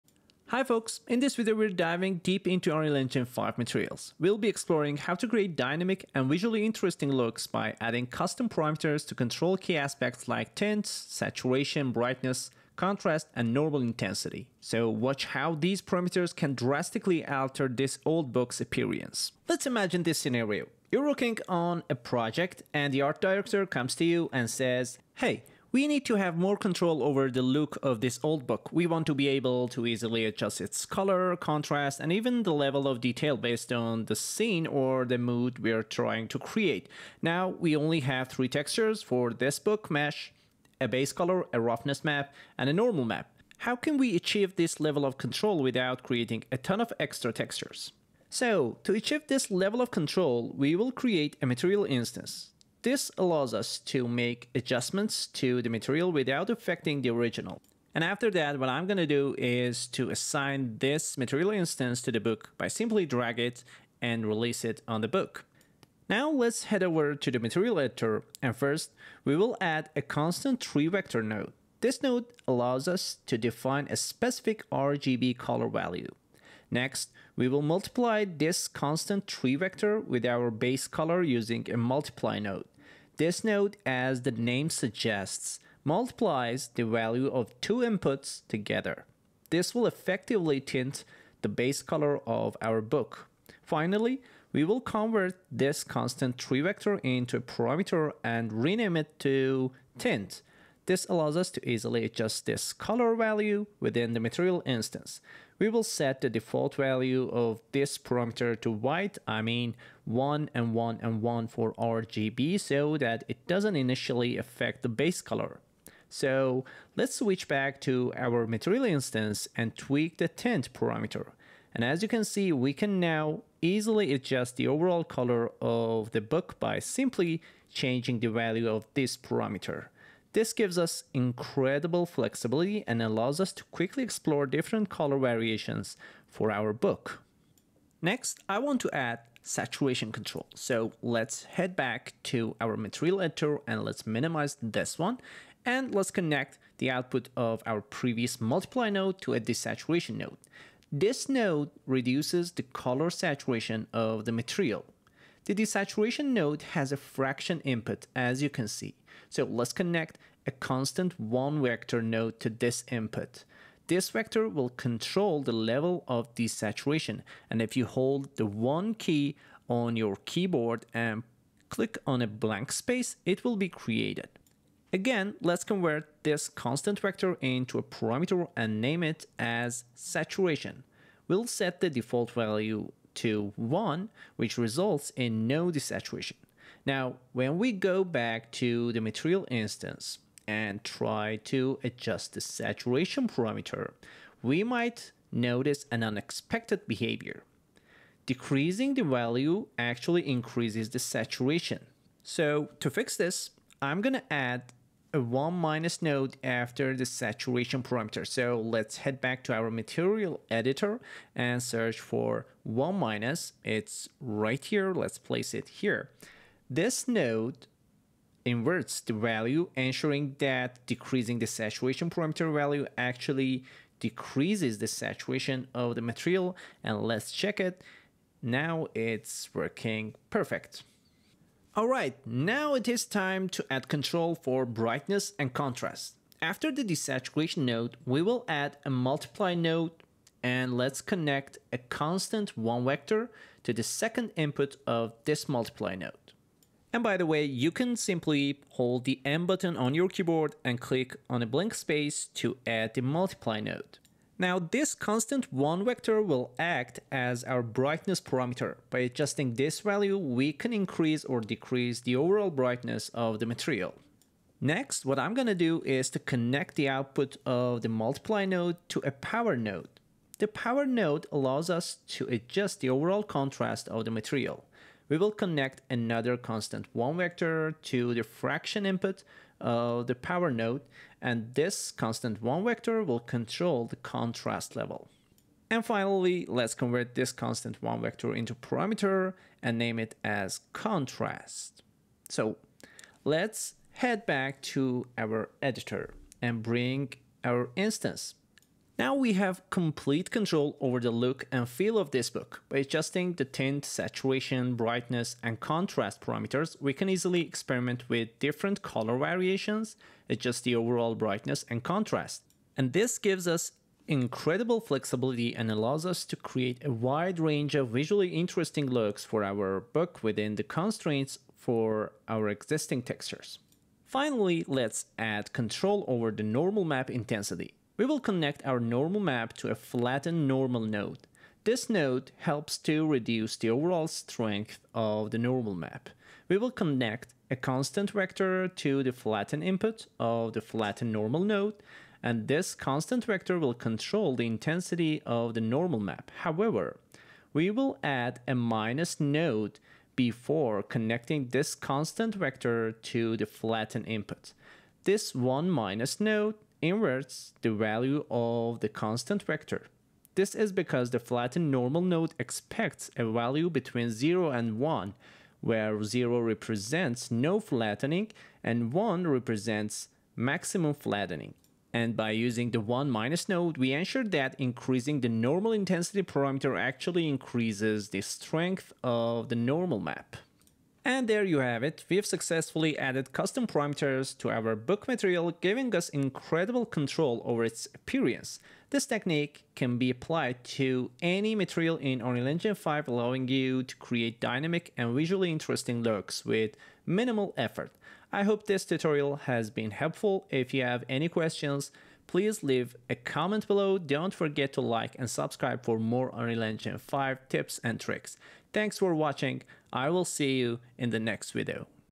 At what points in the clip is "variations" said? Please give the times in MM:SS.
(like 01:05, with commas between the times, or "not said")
02:15, 05:09.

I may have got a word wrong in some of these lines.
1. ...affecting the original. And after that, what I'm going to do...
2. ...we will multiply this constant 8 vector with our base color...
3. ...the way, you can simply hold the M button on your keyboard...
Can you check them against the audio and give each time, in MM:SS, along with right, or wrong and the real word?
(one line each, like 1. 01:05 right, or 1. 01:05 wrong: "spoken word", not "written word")
1. 00:56 right
2. 01:17 wrong: "3", not "8"
3. 04:07 right.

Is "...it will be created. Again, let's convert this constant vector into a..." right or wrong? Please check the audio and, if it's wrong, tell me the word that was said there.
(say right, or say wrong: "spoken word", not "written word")
right.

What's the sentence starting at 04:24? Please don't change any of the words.
Next, what I'm gonna do is to connect the output of the multiply node to a power node.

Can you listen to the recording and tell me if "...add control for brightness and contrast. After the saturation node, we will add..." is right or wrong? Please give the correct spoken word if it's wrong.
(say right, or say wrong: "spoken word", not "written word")
wrong: "desaturation", not "saturation".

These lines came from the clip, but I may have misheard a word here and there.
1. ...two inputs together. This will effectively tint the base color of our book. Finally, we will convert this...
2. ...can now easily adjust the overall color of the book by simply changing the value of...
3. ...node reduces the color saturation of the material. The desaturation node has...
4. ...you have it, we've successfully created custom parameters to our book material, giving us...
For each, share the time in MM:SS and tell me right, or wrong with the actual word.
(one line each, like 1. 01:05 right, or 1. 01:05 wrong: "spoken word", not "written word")
1. 01:27 right
2. 02:02 right
3. 02:31 right
4. 06:21 wrong: "added", not "created".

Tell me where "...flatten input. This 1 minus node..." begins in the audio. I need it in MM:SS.
05:53.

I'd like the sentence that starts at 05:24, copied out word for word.
Finally, let's add control over the normal map intensity.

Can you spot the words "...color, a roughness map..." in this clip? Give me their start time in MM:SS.
00:41.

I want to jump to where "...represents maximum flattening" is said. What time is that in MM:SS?
06:09.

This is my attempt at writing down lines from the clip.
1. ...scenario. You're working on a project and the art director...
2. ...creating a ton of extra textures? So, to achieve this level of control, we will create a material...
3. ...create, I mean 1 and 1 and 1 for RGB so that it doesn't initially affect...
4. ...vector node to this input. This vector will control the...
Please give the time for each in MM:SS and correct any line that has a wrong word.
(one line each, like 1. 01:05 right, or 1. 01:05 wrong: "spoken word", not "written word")
1. 00:20 right
2. 00:46 right
3. 01:48 wrong: "white", not "create"
4. 02:41 right.